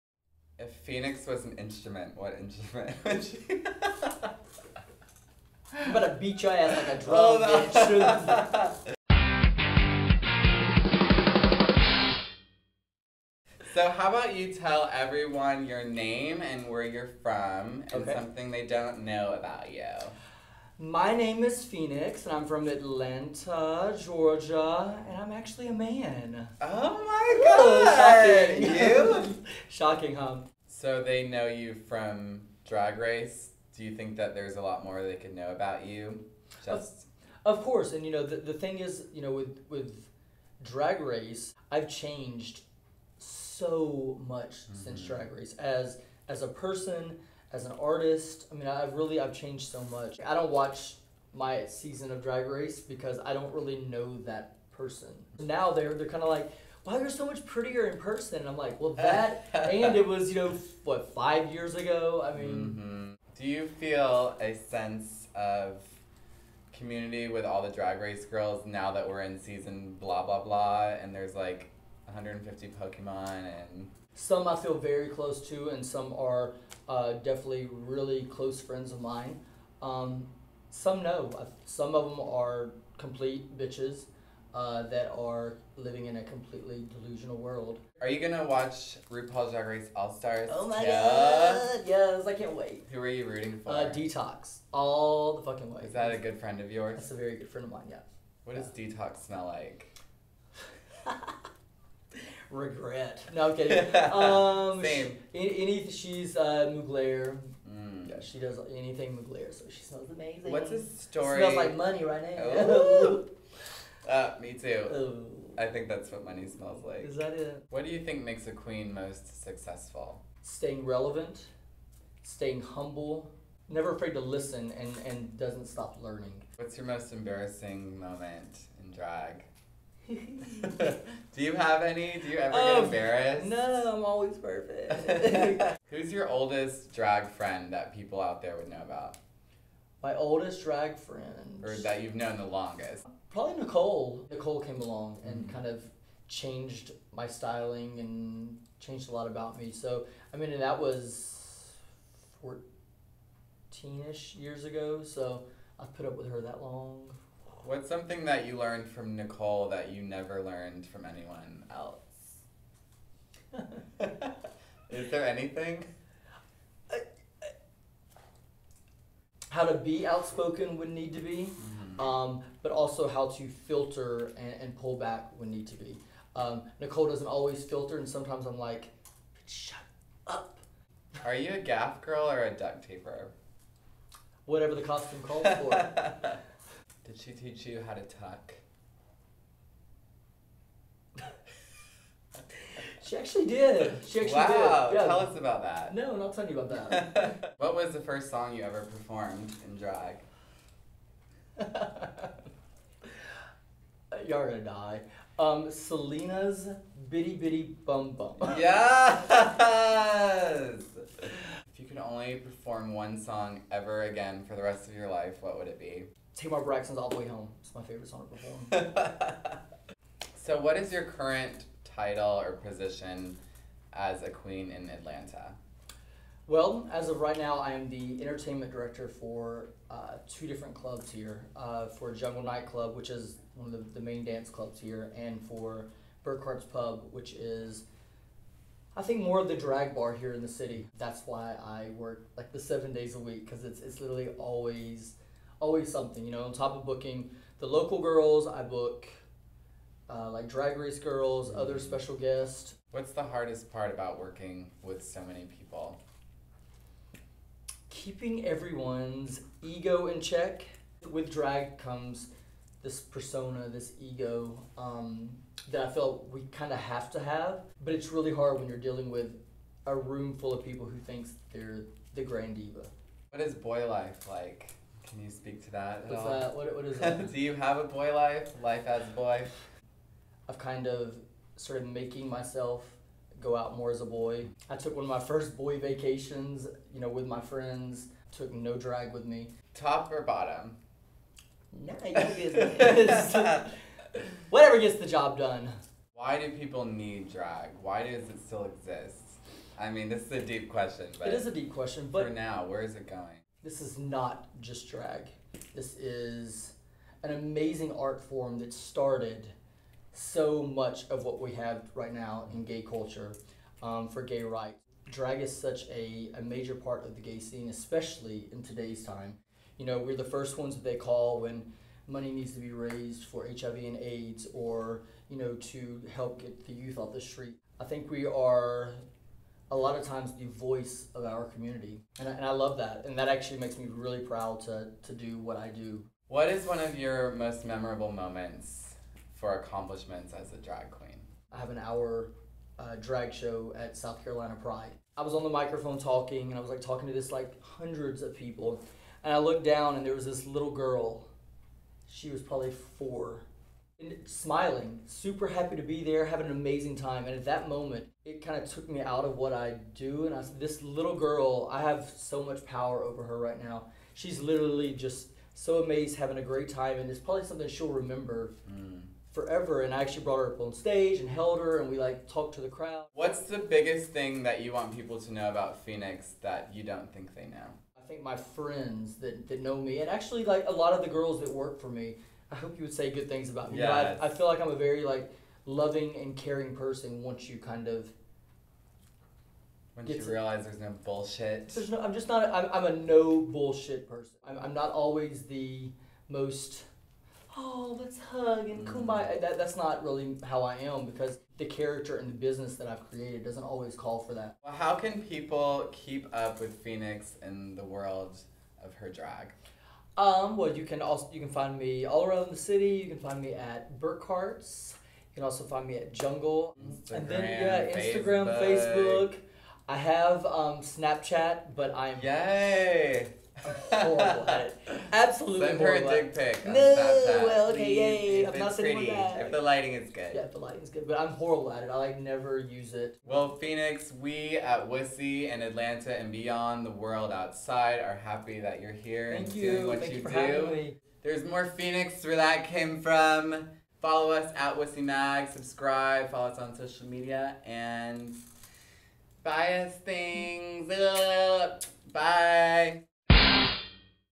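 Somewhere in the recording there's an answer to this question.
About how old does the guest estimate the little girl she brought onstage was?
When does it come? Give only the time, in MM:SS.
05:52.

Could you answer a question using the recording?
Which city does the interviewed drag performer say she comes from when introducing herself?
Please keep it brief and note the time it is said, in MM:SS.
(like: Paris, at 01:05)
Atlanta, Georgia, at 00:22.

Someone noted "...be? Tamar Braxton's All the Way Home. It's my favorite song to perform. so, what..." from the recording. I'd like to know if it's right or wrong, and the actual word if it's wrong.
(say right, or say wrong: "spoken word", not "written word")
right.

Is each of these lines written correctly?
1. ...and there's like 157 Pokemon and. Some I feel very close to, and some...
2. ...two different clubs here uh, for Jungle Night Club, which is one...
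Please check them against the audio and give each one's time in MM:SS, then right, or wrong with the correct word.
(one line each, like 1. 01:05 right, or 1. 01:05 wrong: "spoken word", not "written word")
1. 01:11 wrong: "150", not "157"
2. 03:50 right.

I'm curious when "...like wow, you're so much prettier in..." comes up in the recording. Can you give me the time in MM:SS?
00:56.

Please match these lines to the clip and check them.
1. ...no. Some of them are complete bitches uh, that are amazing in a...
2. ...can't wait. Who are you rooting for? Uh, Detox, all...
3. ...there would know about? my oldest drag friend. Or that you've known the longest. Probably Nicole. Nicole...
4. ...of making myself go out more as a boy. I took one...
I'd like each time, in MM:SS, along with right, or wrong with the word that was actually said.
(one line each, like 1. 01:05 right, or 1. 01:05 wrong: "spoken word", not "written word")
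1. 01:21 wrong: "living", not "amazing"
2. 01:32 right
3. 02:18 right
4. 04:41 right.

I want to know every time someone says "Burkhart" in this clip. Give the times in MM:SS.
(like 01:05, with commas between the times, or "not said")
03:56, 06:53.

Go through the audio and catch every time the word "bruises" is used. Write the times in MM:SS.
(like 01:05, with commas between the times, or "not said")
not said.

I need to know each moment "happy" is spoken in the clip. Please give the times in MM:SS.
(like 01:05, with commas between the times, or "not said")
05:55, 07:18.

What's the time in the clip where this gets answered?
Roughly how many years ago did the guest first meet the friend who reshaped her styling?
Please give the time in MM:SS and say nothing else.
02:32.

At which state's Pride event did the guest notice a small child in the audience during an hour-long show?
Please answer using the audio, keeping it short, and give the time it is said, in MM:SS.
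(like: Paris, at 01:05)
South Carolina, at 05:43.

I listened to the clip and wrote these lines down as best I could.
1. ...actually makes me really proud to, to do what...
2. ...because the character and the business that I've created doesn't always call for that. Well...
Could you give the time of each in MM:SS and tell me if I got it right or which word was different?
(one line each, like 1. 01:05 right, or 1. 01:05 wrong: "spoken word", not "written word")
1. 05:33 right
2. 06:41 right.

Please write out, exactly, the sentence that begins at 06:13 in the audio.
What's the biggest thing that you want people to know about Phoenix that you don't think they know?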